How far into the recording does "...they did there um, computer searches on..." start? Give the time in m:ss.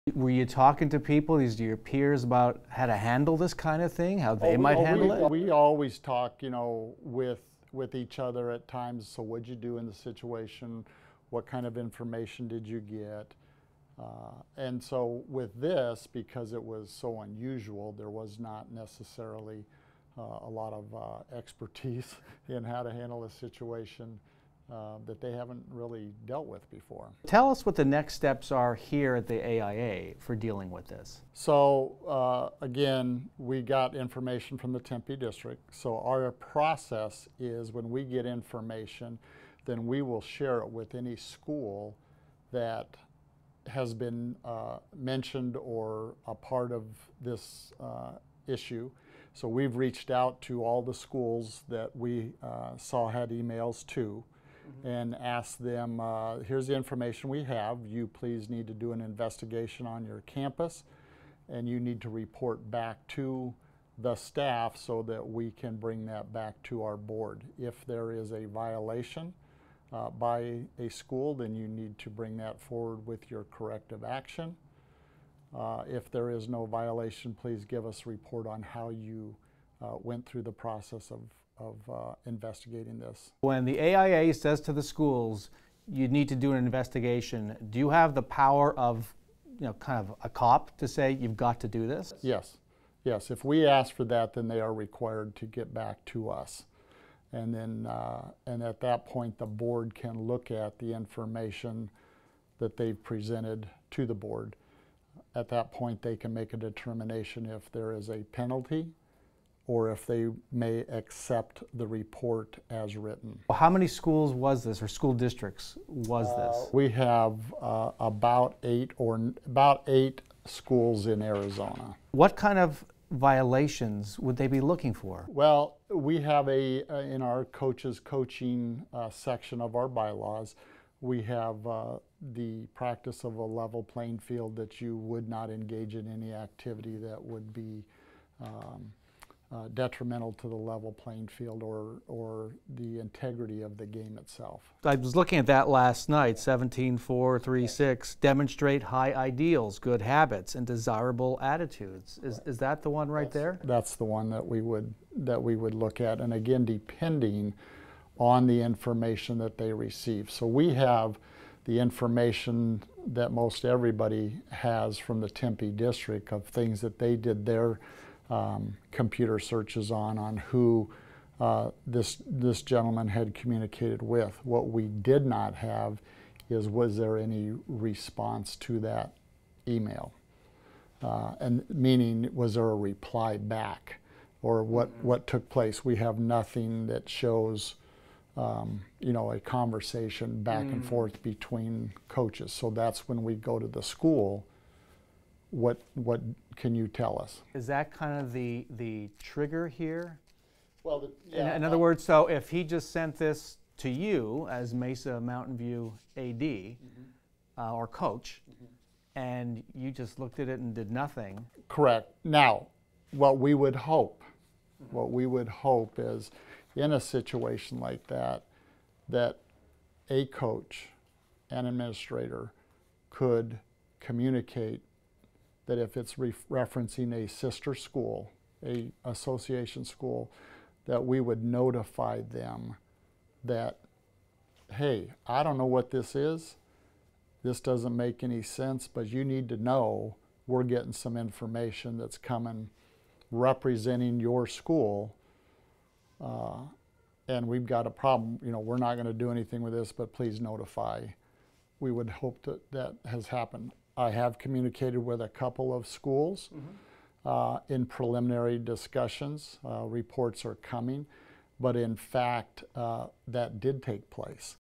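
2:46.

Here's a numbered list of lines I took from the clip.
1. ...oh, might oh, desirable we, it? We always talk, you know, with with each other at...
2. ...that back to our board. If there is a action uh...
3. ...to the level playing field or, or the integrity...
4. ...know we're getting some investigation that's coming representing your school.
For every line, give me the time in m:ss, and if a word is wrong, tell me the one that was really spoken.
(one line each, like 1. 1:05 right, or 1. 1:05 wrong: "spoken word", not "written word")
1. 0:04 wrong: "handle", not "desirable"
2. 1:06 wrong: "violation", not "action"
3. 2:20 right
4. 3:59 wrong: "information", not "investigation".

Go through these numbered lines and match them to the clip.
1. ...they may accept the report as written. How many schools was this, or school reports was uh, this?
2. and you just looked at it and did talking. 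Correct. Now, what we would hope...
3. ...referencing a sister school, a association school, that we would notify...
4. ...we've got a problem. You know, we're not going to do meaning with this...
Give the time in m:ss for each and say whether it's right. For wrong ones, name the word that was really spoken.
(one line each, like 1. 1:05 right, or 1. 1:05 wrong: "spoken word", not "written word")
1. 1:50 wrong: "districts", not "reports"
2. 3:29 wrong: "nothing", not "talking"
3. 3:46 right
4. 4:07 wrong: "anything", not "meaning".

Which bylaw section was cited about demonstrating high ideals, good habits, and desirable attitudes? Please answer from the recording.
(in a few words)
17 4, 3 6.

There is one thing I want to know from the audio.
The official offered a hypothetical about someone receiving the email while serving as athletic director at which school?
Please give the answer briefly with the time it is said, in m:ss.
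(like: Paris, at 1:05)
Mesa Mountain View, at 3:24.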